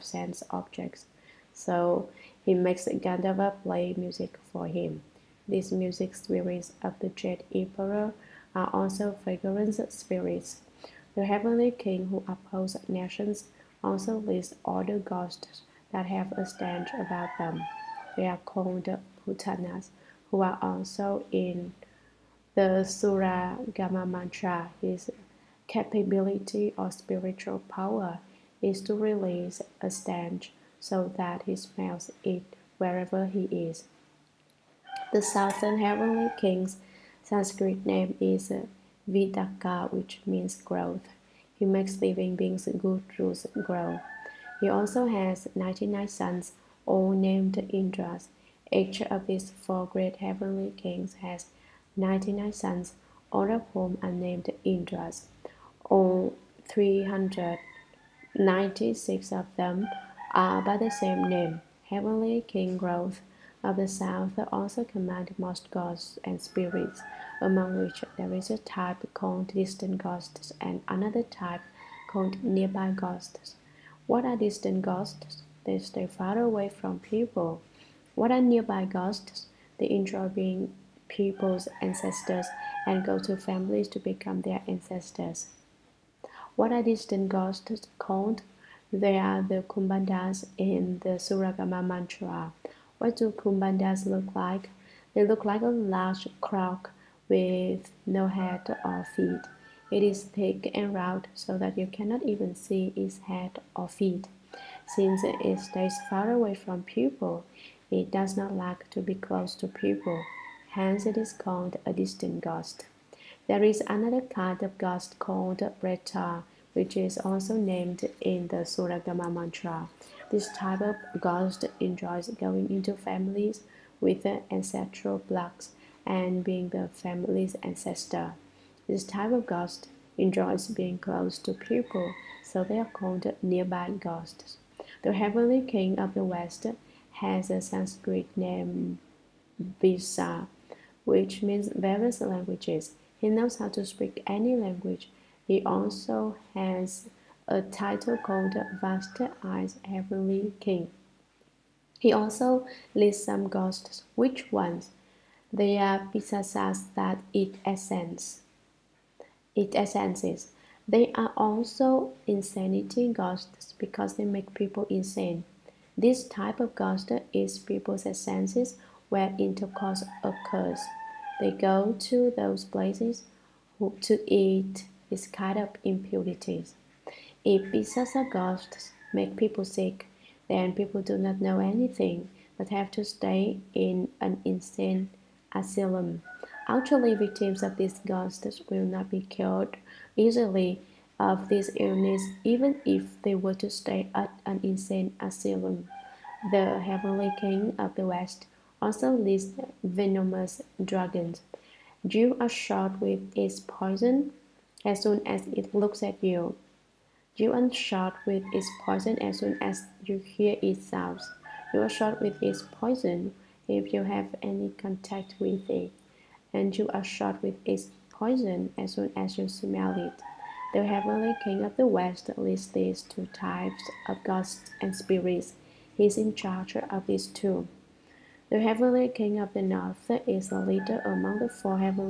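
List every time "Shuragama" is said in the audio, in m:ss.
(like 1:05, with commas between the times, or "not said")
0:22, 1:31, 1:58.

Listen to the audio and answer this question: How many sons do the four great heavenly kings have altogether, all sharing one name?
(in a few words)
396.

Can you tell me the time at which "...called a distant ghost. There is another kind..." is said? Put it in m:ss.
1:51.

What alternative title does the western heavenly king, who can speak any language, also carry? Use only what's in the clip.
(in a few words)
Vaster Eyes Heavenly King.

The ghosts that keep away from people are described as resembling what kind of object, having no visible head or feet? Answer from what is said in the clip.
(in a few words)
A large croc.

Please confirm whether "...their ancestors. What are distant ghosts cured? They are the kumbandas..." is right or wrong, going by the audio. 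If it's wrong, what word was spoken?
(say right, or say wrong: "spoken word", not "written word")
wrong: "called", not "cured".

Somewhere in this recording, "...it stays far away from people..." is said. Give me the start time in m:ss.
1:45.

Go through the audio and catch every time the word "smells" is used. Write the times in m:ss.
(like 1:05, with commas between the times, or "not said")
0:31, 3:39.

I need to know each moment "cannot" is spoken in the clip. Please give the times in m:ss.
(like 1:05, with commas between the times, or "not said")
1:41.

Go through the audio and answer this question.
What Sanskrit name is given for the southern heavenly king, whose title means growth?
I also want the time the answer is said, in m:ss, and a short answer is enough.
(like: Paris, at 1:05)
Vidaka, at 0:39.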